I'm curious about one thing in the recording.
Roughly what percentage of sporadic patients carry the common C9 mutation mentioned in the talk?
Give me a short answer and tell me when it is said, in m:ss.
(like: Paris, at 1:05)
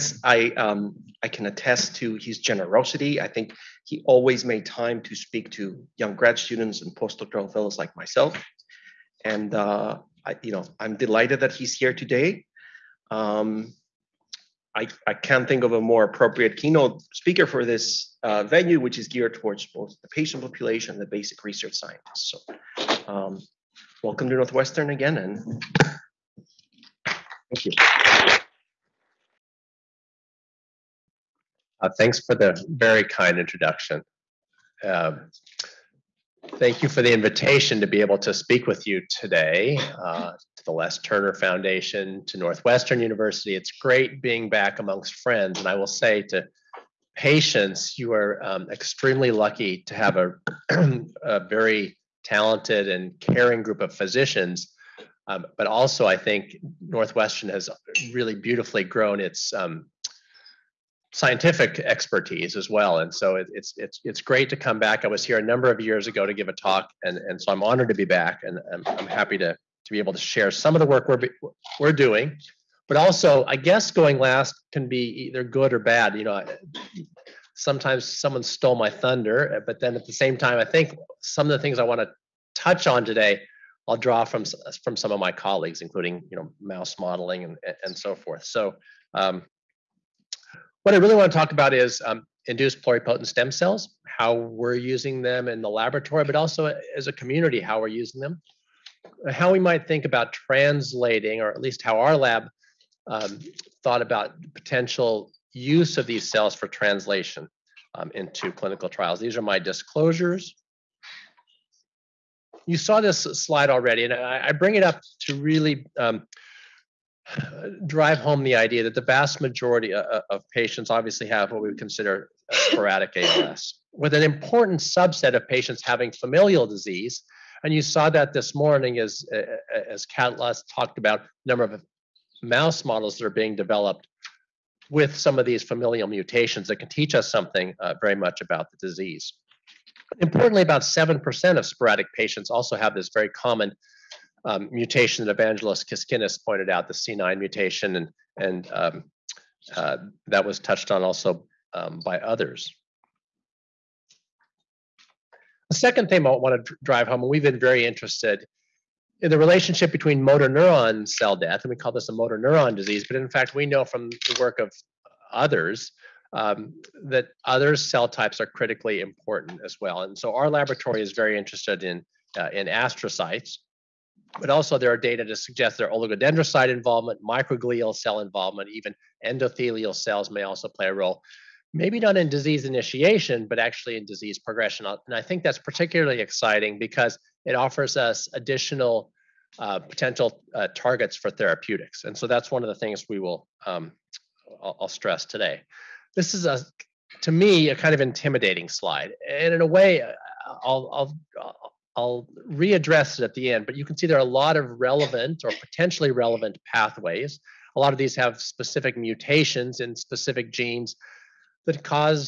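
7%, at 2:20.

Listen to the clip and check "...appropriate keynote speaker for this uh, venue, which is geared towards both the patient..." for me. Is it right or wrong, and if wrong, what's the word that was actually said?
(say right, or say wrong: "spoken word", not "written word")
right.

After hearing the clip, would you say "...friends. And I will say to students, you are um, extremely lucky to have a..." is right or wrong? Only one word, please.
wrong.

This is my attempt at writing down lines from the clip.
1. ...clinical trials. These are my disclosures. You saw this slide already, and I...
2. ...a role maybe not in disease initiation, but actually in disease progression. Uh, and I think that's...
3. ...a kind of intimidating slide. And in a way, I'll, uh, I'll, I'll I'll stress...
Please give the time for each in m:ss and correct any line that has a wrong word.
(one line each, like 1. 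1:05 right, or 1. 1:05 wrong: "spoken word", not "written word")
1. 1:48 right
2. 3:00 right
3. 3:17 wrong: "readdress", not "stress".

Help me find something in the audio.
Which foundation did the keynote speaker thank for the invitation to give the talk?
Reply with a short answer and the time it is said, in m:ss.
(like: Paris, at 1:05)
Les Turner Foundation, at 0:40.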